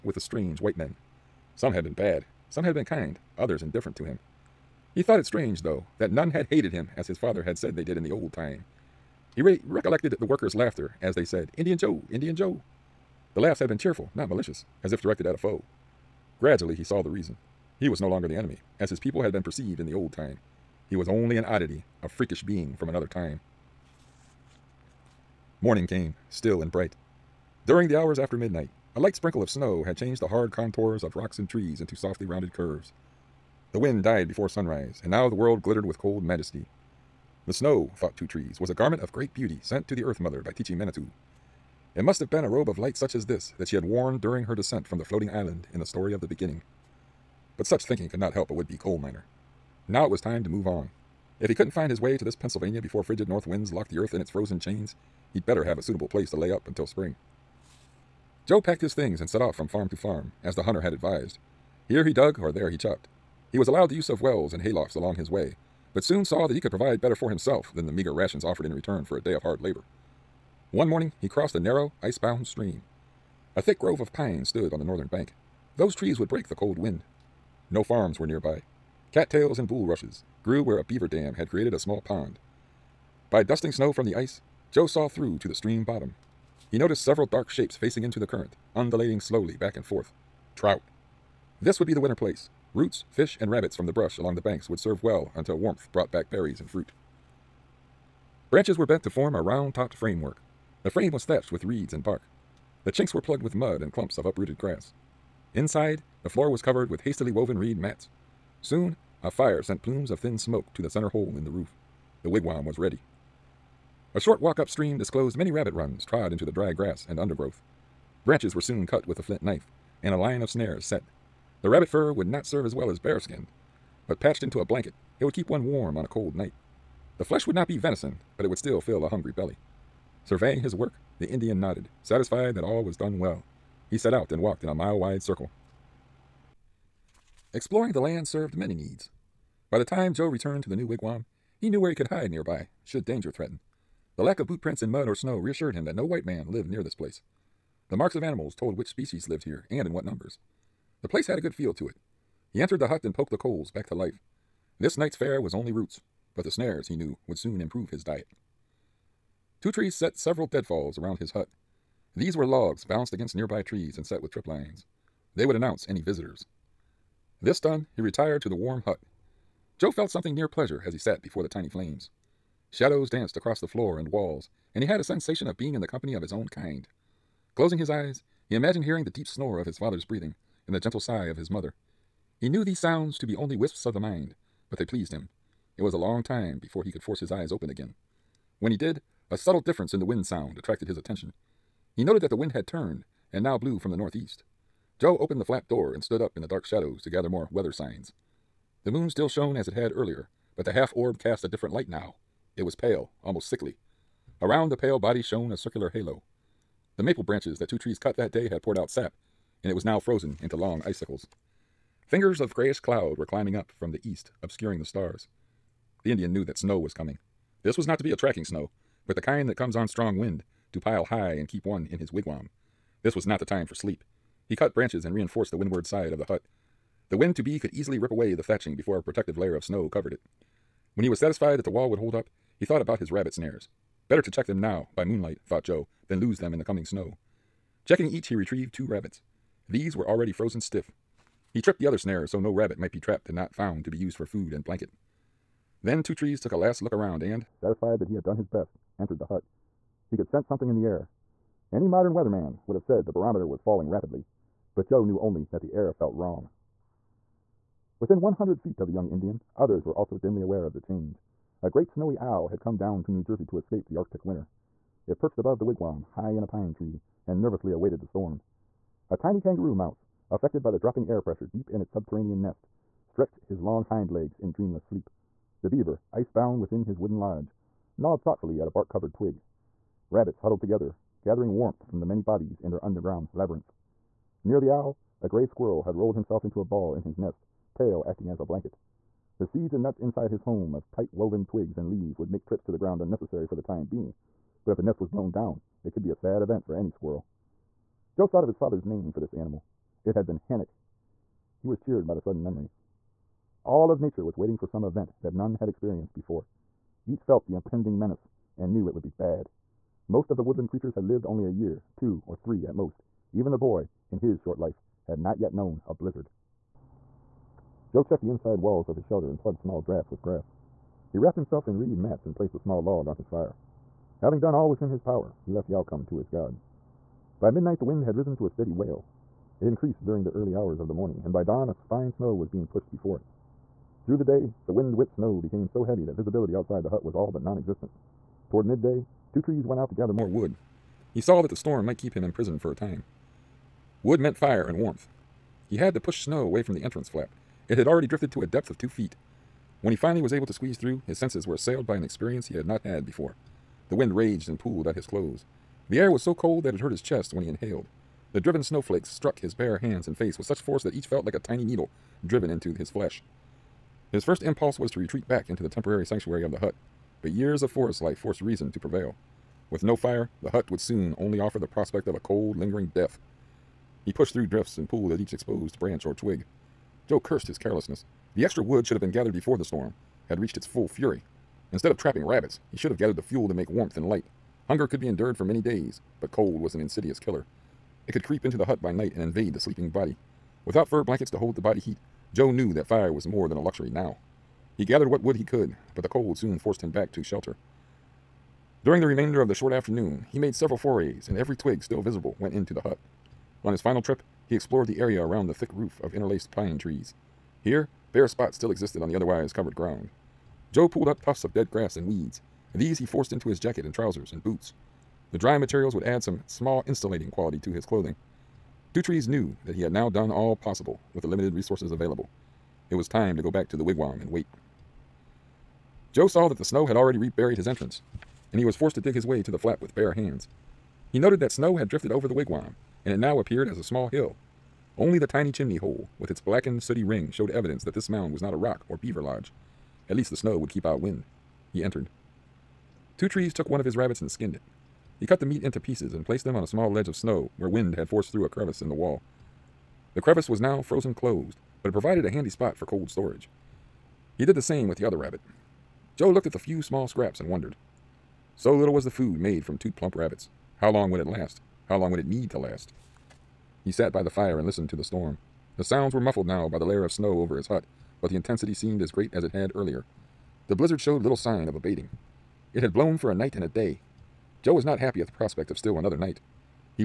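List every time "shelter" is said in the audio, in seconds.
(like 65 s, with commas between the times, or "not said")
319 s, 397 s.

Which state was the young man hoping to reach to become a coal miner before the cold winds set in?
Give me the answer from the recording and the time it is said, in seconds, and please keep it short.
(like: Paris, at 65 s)
Pennsylvania, at 52 s.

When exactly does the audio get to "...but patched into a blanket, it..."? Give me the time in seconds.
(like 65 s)
124 s.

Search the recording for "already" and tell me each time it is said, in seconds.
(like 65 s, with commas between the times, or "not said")
240 s, 347 s, 426 s.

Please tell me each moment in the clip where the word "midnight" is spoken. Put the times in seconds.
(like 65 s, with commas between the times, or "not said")
28 s, 327 s.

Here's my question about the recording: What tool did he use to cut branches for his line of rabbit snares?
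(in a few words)
flint knife.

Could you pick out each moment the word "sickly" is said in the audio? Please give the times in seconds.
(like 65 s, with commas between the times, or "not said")
203 s.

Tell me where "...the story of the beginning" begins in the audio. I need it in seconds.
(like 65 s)
45 s.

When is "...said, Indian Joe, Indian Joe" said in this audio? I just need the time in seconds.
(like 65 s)
11 s.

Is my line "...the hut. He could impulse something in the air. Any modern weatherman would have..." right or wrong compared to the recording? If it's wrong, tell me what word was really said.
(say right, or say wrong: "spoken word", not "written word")
wrong: "sense", not "impulse".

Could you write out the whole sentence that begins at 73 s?
A thick grove of pines stood on the northern bank.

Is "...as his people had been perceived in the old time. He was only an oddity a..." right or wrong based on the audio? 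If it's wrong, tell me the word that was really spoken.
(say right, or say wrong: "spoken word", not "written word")
right.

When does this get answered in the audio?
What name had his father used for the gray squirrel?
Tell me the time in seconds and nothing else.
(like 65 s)
300 s.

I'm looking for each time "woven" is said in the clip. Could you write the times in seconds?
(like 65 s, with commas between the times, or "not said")
107 s, 291 s.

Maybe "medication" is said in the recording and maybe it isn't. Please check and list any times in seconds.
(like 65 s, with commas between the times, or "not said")
not said.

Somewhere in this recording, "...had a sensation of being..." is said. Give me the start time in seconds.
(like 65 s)
174 s.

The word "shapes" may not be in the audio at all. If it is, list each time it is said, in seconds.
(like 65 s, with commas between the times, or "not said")
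87 s.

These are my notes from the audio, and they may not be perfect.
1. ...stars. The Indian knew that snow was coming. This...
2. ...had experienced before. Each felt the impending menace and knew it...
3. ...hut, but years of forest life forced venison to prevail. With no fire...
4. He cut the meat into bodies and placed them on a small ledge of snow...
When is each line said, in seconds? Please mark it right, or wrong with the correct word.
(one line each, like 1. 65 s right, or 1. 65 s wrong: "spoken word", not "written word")
1. 214 s right
2. 305 s right
3. 366 s wrong: "reason", not "venison"
4. 445 s wrong: "pieces", not "bodies".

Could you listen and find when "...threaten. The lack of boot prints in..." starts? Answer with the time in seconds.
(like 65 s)
143 s.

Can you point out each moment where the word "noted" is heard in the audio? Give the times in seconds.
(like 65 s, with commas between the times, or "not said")
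192 s, 431 s.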